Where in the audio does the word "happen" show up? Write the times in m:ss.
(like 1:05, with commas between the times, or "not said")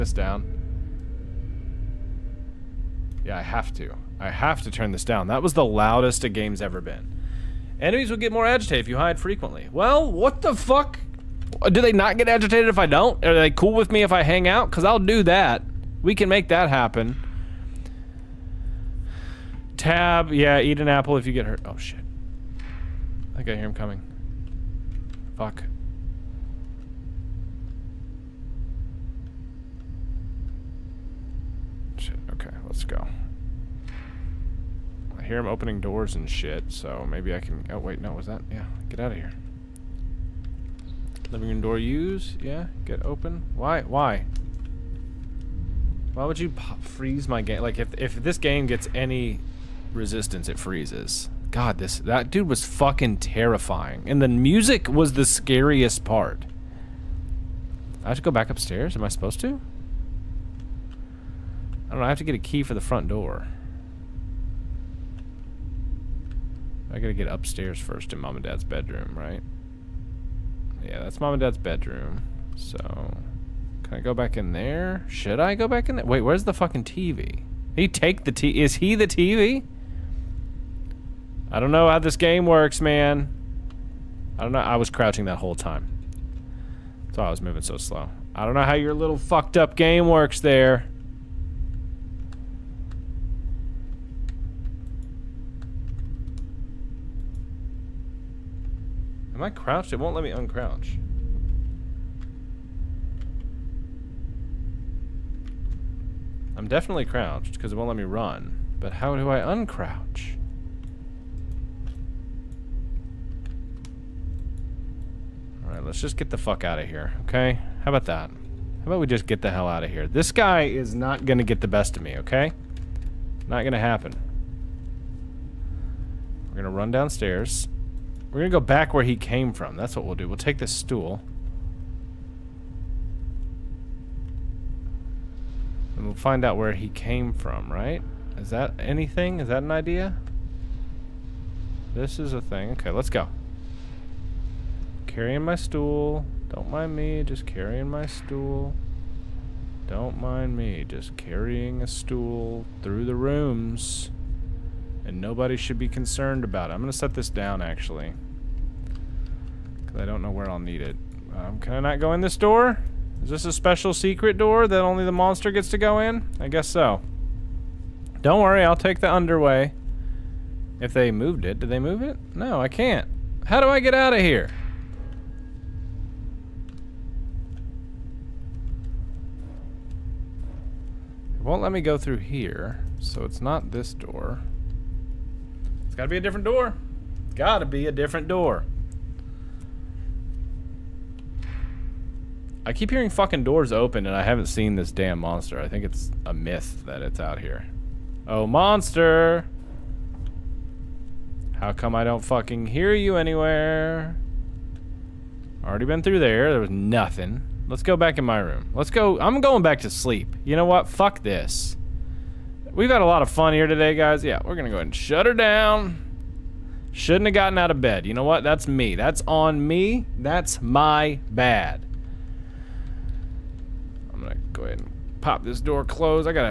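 0:16, 2:03.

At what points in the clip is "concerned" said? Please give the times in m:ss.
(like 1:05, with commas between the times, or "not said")
2:35.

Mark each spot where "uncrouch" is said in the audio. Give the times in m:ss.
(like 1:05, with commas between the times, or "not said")
1:40, 1:49.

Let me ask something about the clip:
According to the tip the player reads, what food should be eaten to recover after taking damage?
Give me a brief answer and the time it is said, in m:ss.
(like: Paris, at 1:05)
An apple, at 0:20.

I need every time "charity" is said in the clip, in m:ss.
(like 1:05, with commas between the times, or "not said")
not said.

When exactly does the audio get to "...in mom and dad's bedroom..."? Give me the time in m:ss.
1:08.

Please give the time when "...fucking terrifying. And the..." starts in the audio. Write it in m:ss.
0:52.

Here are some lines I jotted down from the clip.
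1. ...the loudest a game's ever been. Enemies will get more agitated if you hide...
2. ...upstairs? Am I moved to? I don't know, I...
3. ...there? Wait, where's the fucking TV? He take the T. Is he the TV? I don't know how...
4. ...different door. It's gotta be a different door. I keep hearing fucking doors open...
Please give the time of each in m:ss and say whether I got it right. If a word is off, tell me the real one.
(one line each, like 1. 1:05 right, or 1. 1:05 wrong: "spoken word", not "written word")
1. 0:05 right
2. 0:58 wrong: "supposed", not "moved"
3. 1:15 right
4. 3:06 right.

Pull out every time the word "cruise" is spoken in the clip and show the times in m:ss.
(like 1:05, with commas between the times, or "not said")
not said.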